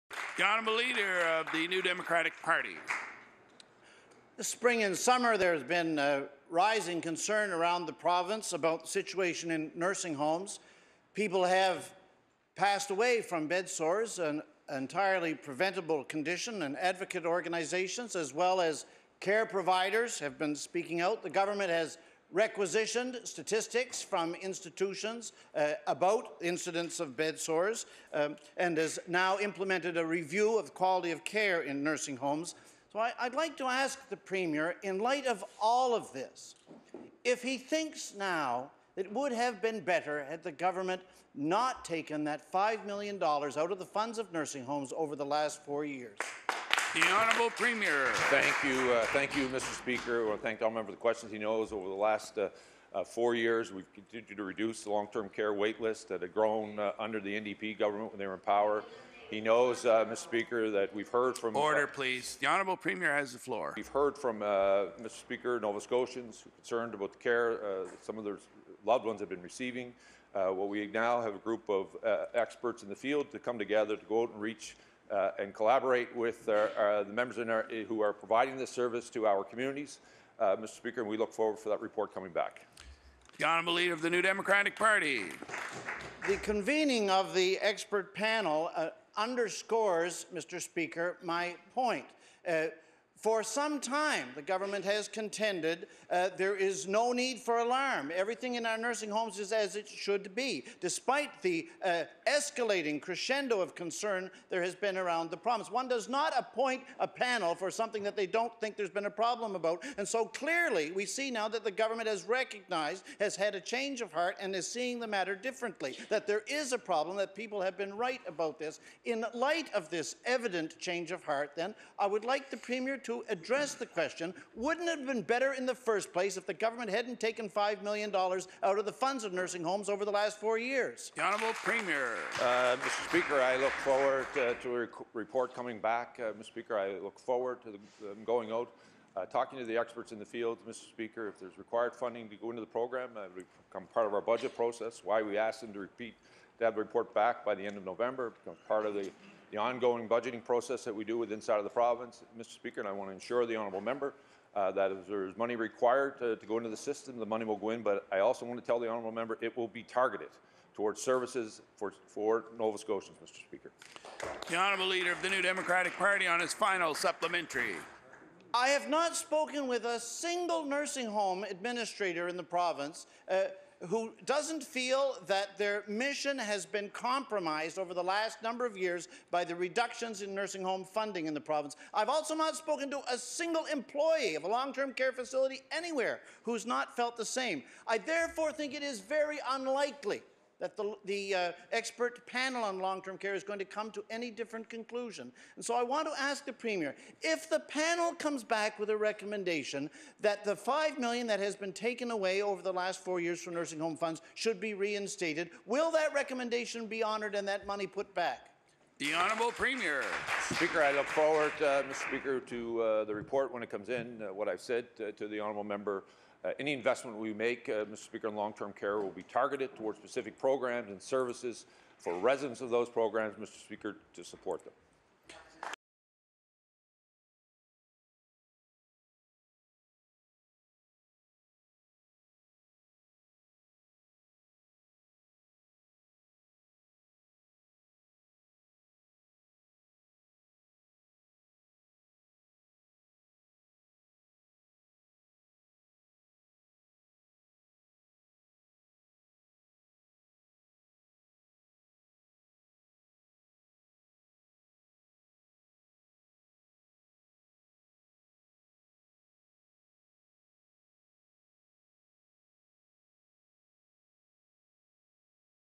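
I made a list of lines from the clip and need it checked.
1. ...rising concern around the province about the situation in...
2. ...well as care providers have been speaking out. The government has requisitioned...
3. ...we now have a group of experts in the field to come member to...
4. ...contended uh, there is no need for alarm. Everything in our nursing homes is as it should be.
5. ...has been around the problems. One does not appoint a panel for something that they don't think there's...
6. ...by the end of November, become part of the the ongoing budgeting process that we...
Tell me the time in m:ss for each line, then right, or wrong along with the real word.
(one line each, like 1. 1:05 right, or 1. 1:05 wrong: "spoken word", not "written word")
1. 0:06 right
2. 0:18 right
3. 1:10 wrong: "together", not "member"
4. 1:35 right
5. 1:44 right
6. 2:27 right.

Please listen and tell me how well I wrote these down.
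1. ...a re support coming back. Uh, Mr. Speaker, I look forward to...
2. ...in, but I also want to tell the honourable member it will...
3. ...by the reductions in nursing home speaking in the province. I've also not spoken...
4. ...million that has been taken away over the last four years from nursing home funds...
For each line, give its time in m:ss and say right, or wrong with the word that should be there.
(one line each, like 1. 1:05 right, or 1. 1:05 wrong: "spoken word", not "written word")
1. 2:14 wrong: "report", not "support"
2. 2:37 right
3. 2:59 wrong: "funding", not "speaking"
4. 3:20 right.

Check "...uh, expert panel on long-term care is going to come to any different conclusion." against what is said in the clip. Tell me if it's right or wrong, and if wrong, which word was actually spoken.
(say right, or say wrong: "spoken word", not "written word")
right.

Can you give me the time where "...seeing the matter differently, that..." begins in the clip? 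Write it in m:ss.
1:54.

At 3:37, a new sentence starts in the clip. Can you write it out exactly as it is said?
Speaker, in long-term care will be targeted towards specific programs and services for residents of those programs, Mr.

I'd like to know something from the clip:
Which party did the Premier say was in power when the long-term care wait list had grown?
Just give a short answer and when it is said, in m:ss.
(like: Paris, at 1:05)
NDP, at 0:57.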